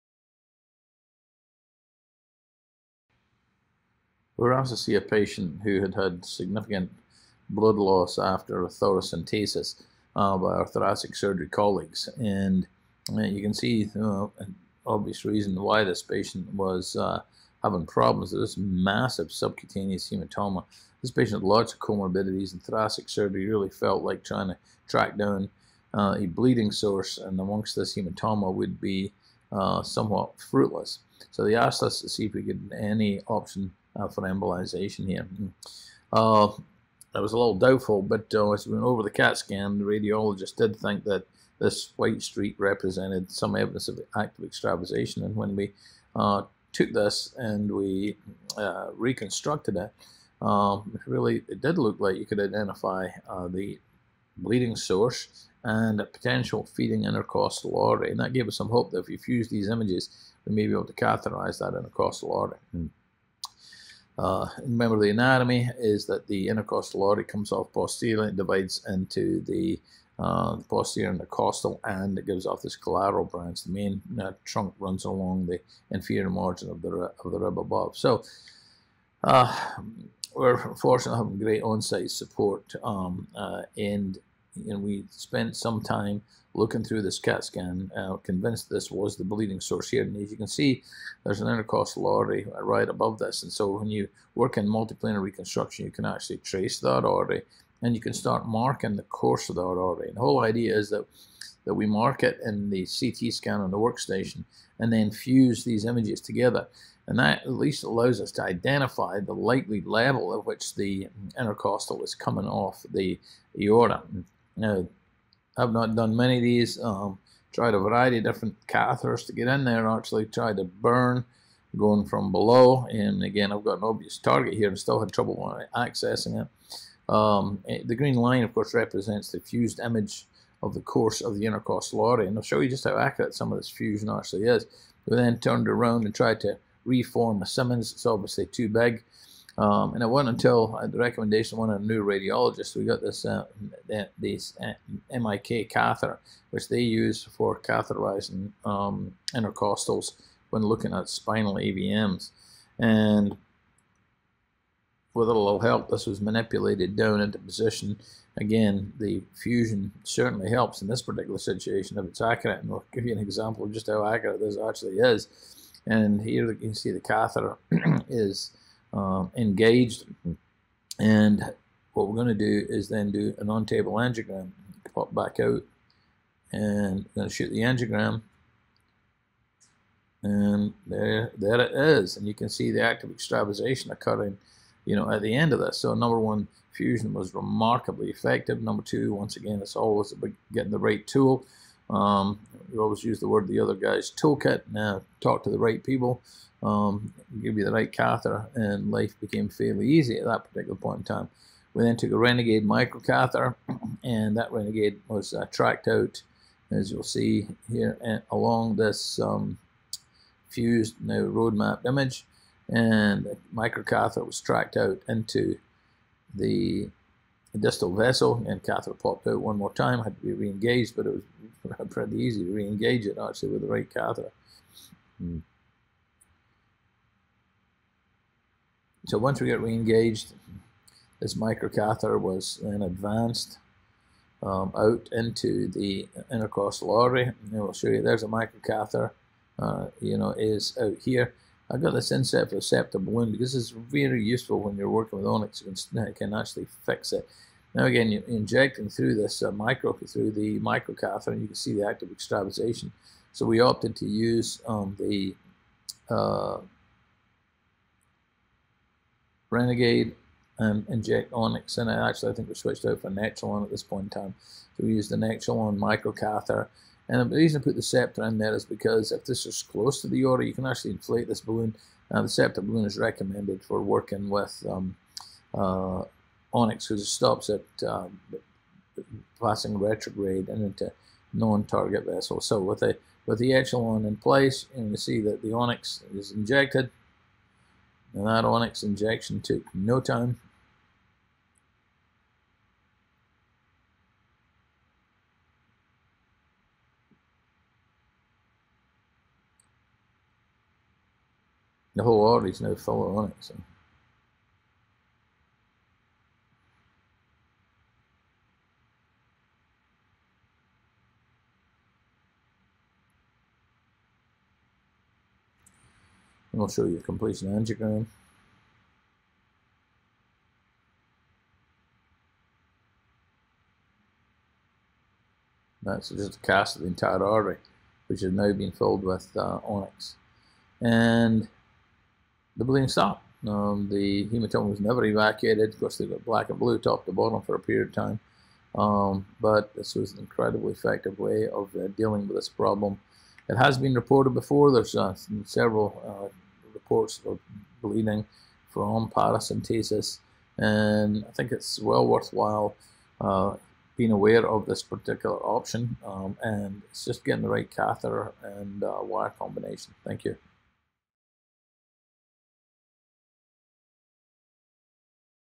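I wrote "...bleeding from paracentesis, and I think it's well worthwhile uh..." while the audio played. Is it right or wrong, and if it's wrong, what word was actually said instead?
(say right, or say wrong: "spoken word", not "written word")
right.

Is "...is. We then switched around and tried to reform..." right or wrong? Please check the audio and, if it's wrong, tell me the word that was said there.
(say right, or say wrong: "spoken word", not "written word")
wrong: "turned", not "switched".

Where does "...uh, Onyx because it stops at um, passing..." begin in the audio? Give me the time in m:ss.
4:35.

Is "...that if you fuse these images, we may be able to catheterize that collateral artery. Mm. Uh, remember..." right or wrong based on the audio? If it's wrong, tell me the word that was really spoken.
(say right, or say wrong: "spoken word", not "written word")
wrong: "intercostal", not "collateral".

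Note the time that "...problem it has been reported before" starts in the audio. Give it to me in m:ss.
5:42.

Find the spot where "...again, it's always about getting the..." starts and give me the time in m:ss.
3:09.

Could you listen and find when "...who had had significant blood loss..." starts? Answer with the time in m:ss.
0:05.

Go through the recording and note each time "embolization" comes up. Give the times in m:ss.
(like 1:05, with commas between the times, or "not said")
0:34.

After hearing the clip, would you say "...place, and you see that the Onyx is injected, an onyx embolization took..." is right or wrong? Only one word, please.
wrong.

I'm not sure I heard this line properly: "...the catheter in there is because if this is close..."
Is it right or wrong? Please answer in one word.
wrong.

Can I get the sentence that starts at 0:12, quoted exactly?
And uh, you can see uh, an obvious reason why this patient was uh, having problems with this massive subcutaneous hematoma.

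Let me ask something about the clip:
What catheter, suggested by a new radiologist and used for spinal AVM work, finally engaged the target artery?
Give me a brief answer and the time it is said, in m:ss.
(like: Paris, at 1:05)
MIK catheter, at 2:25.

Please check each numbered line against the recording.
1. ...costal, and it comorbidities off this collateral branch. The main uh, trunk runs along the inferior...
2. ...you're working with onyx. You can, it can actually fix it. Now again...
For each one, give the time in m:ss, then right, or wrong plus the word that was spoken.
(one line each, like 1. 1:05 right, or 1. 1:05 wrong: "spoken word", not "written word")
1. 1:11 wrong: "gives", not "comorbidities"
2. 4:04 right.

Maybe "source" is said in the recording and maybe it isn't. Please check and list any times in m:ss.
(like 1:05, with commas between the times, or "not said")
0:26, 0:54, 1:29.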